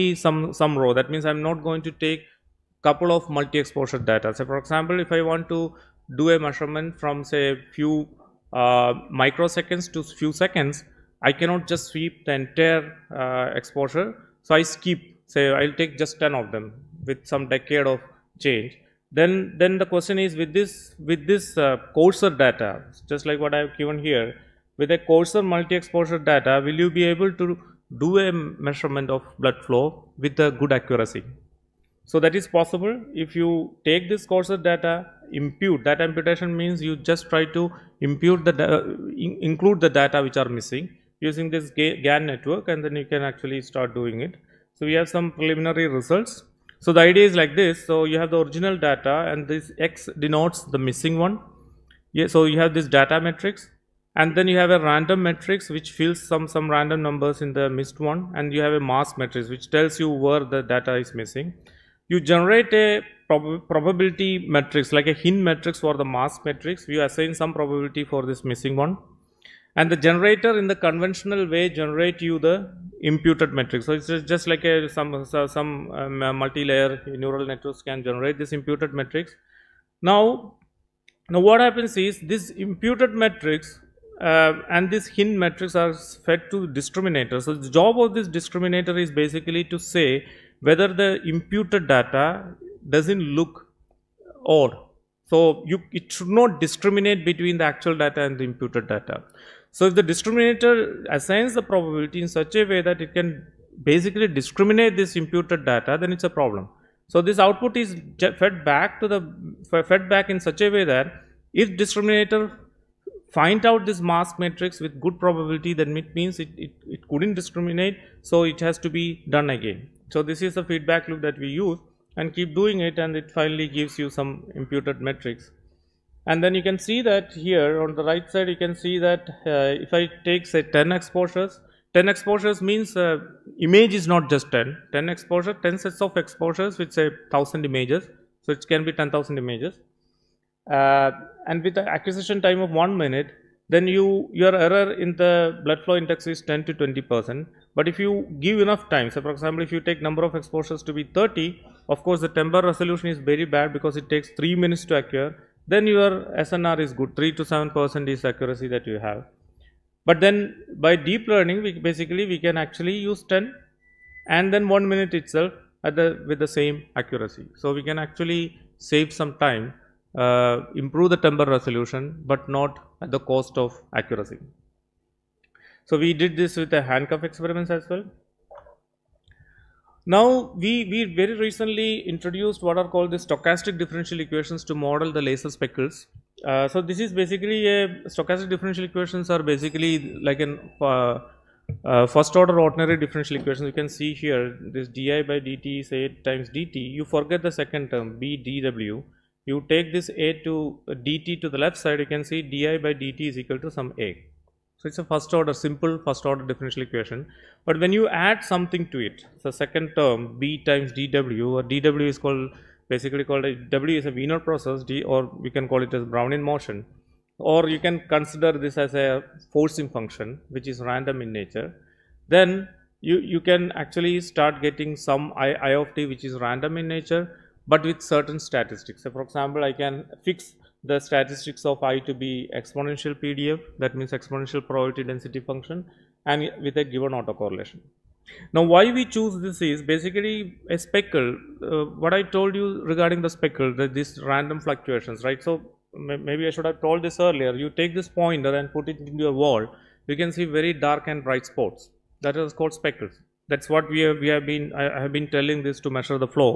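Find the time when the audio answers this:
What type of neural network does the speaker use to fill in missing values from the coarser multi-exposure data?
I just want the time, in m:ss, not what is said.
0:41.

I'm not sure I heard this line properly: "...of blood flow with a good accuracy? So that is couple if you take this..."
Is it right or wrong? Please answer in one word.
wrong.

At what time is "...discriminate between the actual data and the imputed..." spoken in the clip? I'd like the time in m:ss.
1:36.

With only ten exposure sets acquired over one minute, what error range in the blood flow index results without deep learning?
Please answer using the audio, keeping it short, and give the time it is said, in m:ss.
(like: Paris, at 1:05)
10 to 20 percent, at 2:26.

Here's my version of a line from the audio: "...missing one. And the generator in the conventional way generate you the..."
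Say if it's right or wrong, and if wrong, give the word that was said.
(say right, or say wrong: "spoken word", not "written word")
right.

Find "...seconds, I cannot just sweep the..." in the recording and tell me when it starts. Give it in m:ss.
0:10.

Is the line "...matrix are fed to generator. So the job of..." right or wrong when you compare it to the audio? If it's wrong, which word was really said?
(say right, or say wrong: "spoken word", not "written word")
wrong: "discriminator", not "generator".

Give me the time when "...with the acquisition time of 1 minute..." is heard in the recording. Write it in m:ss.
2:21.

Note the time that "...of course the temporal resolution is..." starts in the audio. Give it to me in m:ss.
2:31.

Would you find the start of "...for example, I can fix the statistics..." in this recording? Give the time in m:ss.
3:49.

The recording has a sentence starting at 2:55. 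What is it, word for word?
So we did this with the handcuff experiments as well.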